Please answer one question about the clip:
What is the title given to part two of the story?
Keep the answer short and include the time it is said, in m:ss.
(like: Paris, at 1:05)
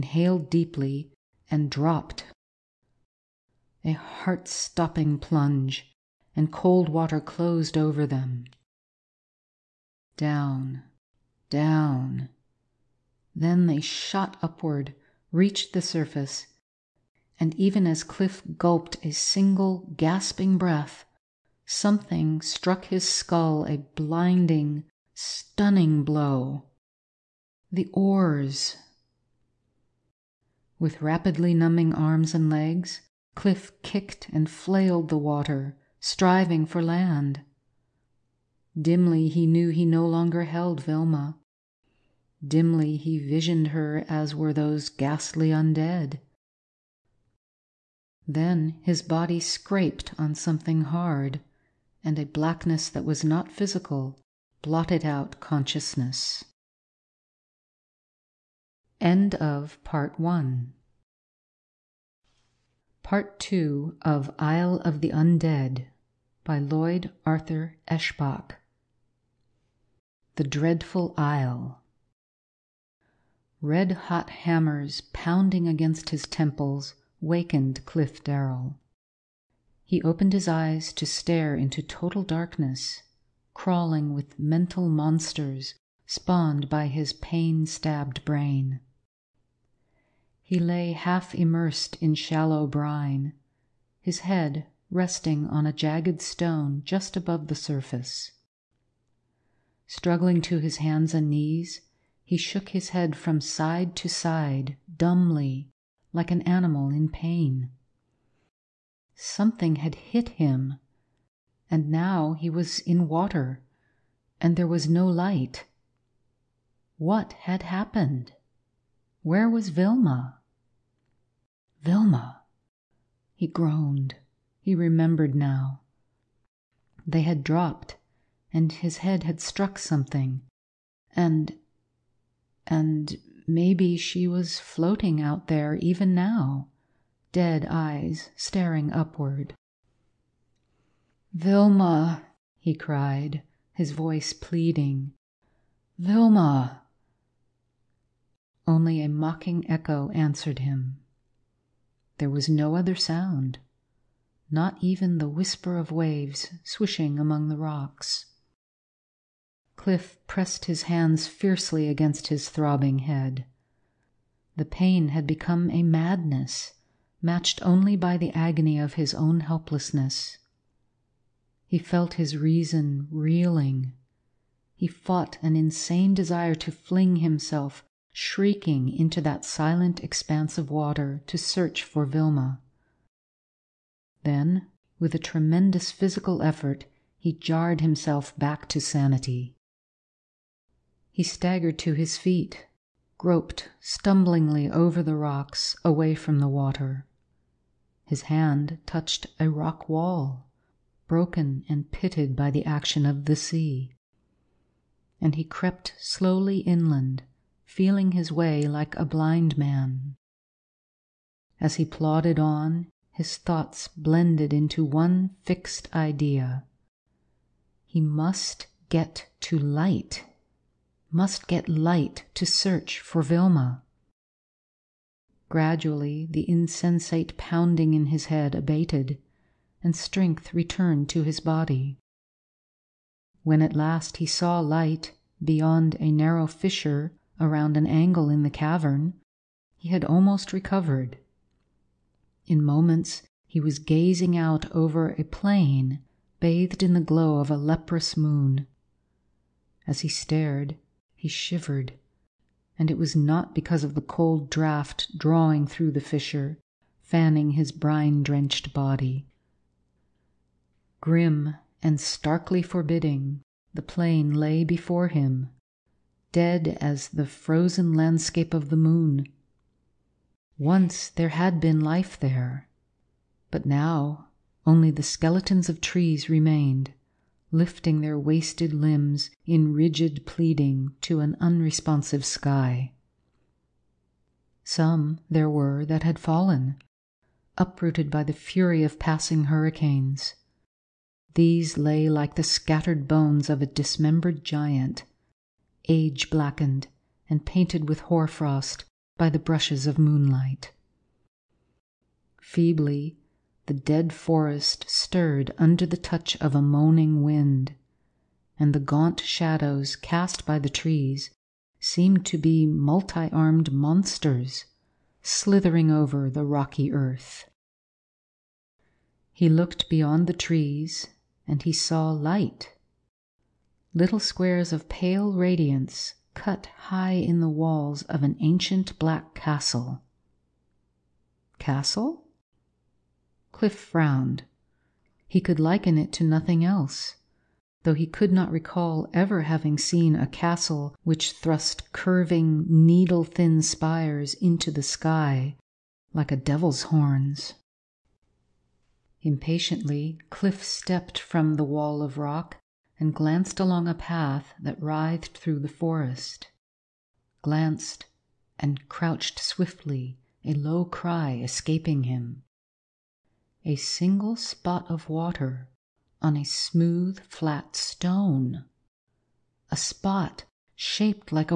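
The Dreadful Isle, at 1:10.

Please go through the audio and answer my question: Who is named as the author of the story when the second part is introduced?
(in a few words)
Lloyd Arthur Eshbach.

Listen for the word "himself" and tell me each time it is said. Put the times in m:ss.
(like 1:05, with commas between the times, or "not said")
2:57, 3:07.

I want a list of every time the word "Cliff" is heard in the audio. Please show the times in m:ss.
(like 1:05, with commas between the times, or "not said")
0:18, 0:33, 1:17, 2:39, 5:33, 5:50.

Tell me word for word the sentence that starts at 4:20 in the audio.
Grim and starkly forbidding, the plain lay before him, dead as the frozen landscape of the moon.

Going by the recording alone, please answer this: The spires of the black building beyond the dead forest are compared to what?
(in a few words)
A devil's horns.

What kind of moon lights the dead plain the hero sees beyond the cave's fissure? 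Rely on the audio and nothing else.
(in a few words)
A leprous moon.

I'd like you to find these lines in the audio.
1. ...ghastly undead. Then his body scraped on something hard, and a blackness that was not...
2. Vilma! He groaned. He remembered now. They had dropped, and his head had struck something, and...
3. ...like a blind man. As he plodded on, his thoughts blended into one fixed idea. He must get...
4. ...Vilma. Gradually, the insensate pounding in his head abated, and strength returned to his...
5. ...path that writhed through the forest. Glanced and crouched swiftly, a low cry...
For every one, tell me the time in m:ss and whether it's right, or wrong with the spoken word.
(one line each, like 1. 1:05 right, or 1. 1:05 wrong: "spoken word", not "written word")
1. 0:44 right
2. 2:01 right
3. 3:28 right
4. 3:43 right
5. 5:53 right.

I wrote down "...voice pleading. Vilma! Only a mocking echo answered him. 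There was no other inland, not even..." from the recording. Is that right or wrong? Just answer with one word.
wrong.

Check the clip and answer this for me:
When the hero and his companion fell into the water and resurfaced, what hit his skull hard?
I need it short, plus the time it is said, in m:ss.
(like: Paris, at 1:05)
The oars, at 0:27.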